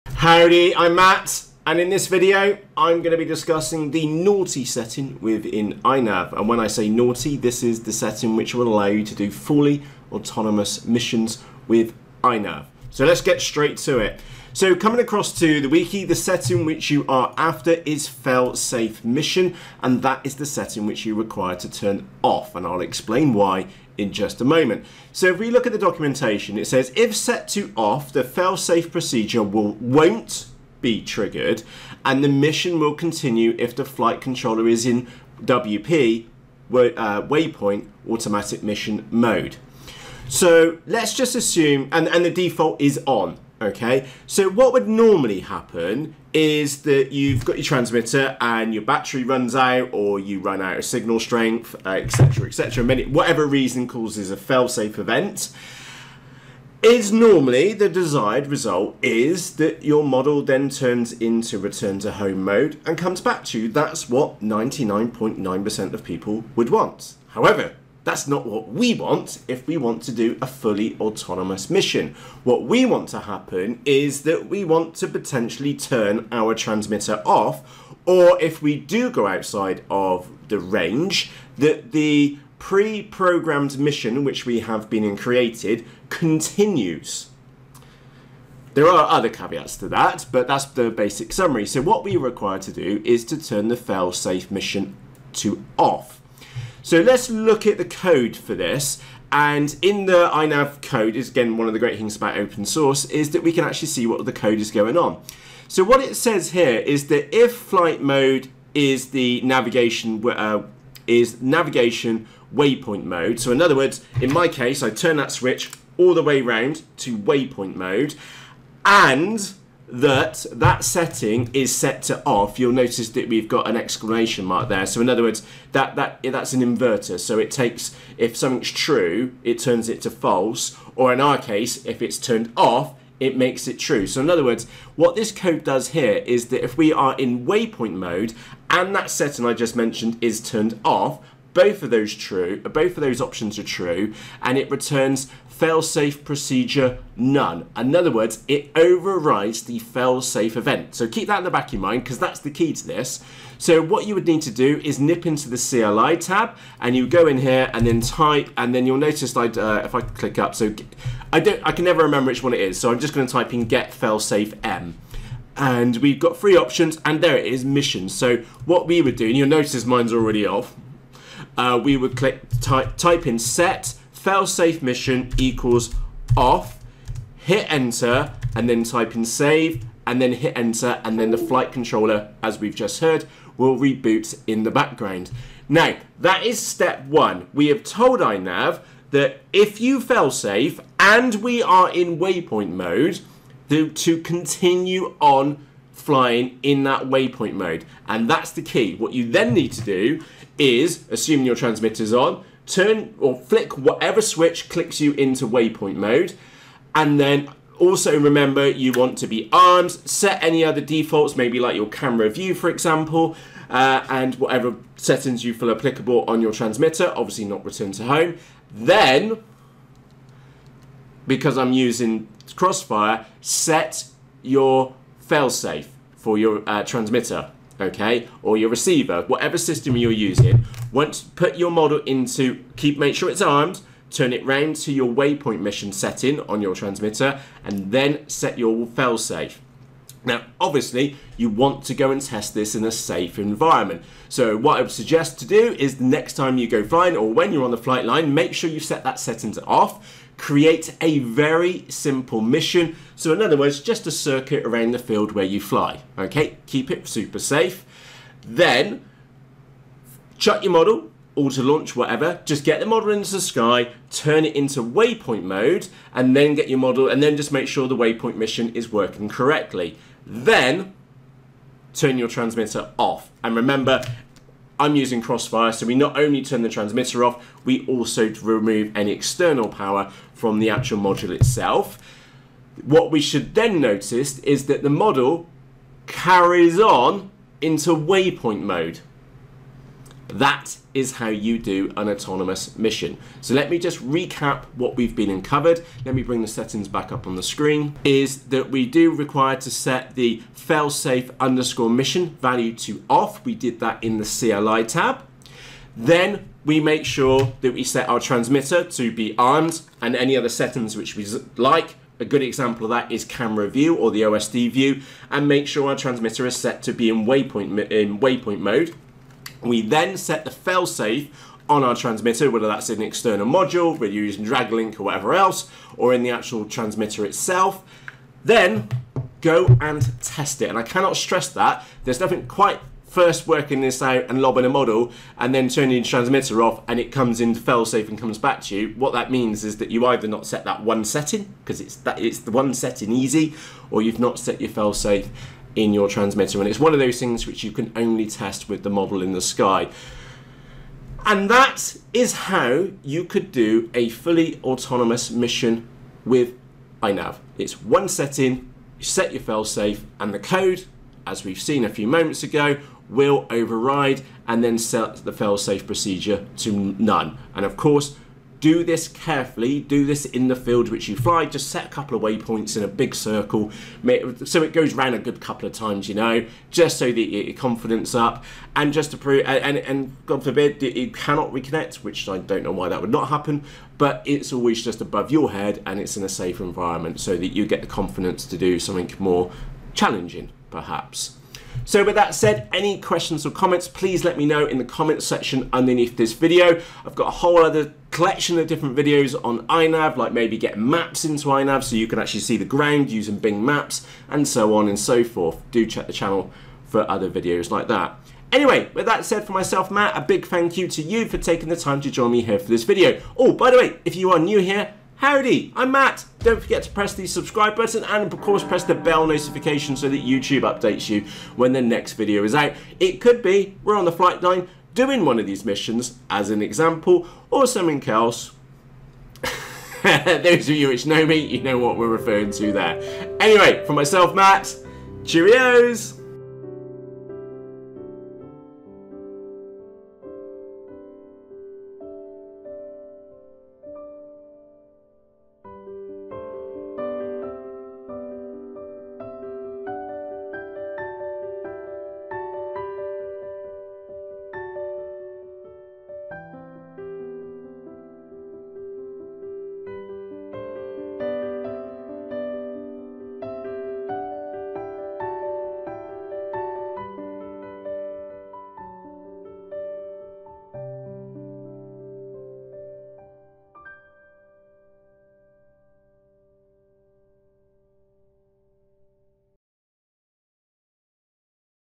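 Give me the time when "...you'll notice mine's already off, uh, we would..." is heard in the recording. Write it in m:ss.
2:49.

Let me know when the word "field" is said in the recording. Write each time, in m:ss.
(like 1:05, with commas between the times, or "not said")
4:14, 6:10.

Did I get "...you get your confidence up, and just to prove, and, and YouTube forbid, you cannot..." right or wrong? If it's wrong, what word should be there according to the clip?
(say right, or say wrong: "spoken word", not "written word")
wrong: "God", not "YouTube".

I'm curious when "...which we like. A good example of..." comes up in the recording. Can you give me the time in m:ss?
5:10.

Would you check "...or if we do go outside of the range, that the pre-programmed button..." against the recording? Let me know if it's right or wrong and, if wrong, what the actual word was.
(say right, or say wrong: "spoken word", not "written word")
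wrong: "mission", not "button".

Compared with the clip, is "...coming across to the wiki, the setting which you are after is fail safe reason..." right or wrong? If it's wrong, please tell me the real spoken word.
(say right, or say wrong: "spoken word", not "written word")
wrong: "mission", not "reason".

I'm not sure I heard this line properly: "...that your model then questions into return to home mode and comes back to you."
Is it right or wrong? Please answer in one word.
wrong.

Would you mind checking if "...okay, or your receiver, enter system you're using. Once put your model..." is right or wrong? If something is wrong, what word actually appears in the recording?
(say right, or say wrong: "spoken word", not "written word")
wrong: "whatever", not "enter".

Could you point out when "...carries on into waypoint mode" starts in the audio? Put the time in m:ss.
4:46.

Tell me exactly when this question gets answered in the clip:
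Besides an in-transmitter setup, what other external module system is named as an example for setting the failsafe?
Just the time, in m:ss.
5:24.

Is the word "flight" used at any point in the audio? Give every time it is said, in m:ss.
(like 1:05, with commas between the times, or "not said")
0:33, 1:47, 3:01, 4:07, 7:04.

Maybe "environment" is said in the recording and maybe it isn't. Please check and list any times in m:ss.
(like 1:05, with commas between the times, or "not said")
4:03, 6:26.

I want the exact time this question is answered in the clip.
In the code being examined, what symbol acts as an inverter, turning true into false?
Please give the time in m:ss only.
2:03.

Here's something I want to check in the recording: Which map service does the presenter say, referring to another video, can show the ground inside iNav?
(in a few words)
Bing Maps.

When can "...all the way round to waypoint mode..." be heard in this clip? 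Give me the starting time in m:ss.
1:55.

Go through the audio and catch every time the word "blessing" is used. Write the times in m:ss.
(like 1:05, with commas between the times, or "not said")
not said.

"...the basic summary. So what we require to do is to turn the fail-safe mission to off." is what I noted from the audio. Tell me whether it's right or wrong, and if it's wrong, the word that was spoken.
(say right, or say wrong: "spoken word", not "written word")
right.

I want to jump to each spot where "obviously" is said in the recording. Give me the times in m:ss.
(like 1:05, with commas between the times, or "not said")
3:37, 4:00.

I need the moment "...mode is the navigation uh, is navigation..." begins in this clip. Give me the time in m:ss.
1:48.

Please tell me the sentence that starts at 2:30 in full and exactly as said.
So keep that in the back of your mind because that's the key to this.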